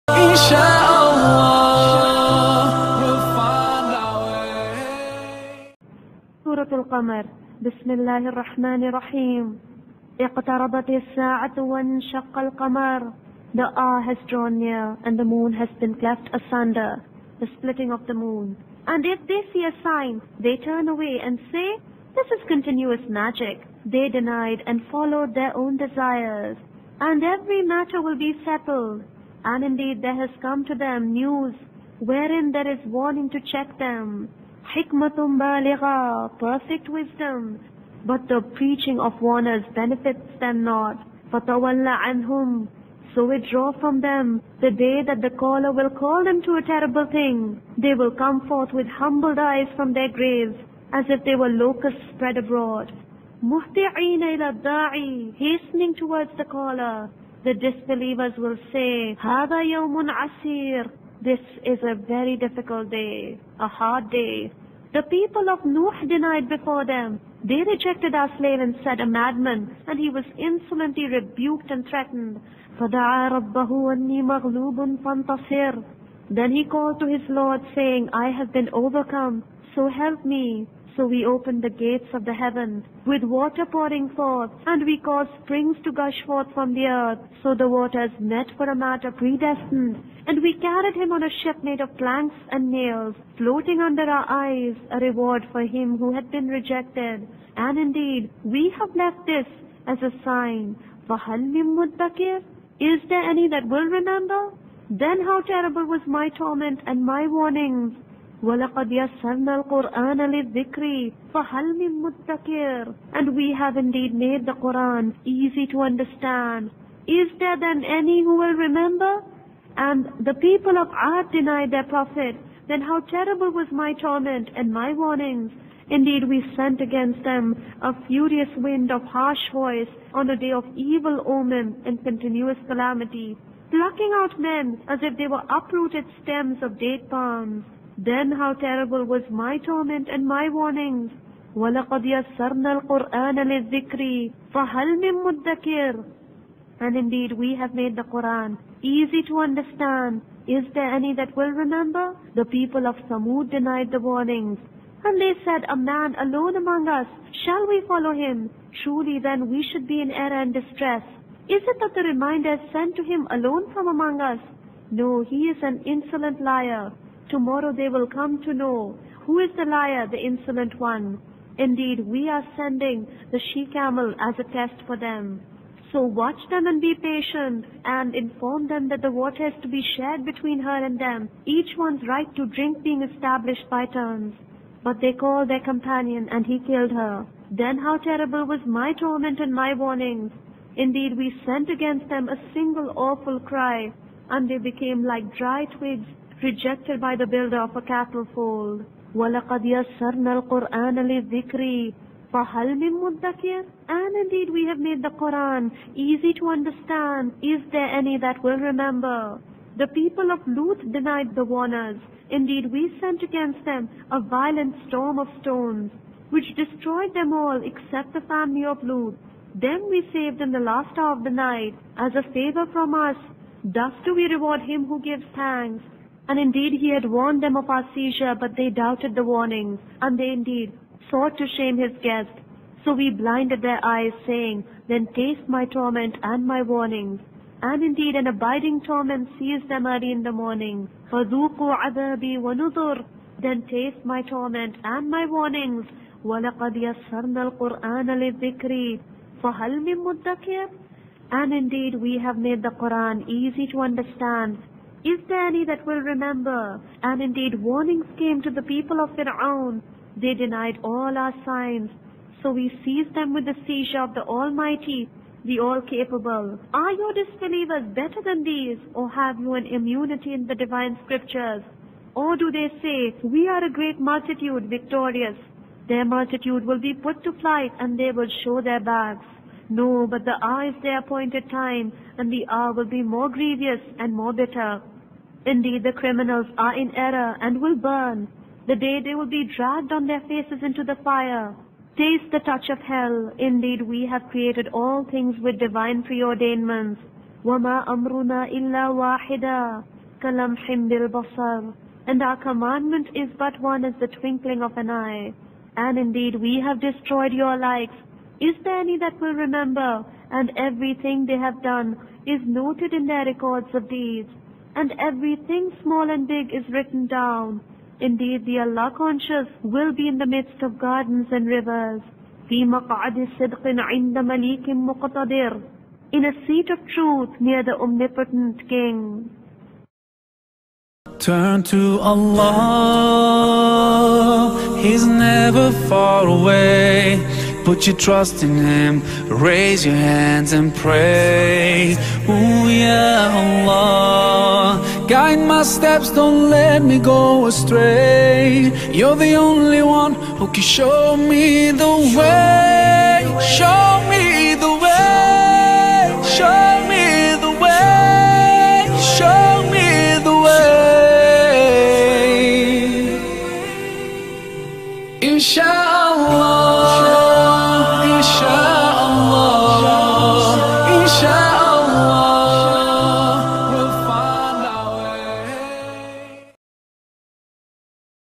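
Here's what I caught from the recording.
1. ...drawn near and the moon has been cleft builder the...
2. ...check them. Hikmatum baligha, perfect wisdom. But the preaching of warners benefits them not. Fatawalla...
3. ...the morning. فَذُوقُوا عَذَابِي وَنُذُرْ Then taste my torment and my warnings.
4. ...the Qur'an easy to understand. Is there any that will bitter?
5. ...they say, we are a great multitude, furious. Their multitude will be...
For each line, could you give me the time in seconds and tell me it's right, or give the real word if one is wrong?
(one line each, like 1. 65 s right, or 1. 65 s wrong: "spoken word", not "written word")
1. 14 s wrong: "asunder", not "builder"
2. 33 s right
3. 240 s right
4. 252 s wrong: "remember", not "bitter"
5. 272 s wrong: "victorious", not "furious".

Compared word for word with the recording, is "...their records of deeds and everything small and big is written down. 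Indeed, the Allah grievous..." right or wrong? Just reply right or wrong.
wrong.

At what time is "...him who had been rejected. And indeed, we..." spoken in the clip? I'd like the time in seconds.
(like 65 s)
95 s.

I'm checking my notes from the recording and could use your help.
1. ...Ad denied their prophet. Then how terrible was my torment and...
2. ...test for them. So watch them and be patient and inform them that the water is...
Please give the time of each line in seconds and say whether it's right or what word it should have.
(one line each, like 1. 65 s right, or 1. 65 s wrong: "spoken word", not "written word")
1. 121 s right
2. 174 s right.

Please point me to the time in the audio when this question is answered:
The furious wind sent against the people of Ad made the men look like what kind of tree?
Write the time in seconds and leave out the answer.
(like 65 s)
136 s.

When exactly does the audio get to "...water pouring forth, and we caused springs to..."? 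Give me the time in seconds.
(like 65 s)
83 s.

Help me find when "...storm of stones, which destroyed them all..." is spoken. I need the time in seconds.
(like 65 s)
214 s.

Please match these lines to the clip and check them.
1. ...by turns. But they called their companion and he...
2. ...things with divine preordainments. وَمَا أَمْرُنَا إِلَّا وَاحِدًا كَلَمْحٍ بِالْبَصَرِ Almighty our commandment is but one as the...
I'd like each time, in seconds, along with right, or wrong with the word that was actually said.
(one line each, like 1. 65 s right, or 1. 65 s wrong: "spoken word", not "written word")
1. 183 s right
2. 295 s wrong: "And", not "Almighty".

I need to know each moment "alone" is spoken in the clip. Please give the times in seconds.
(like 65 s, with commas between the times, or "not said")
156 s, 163 s.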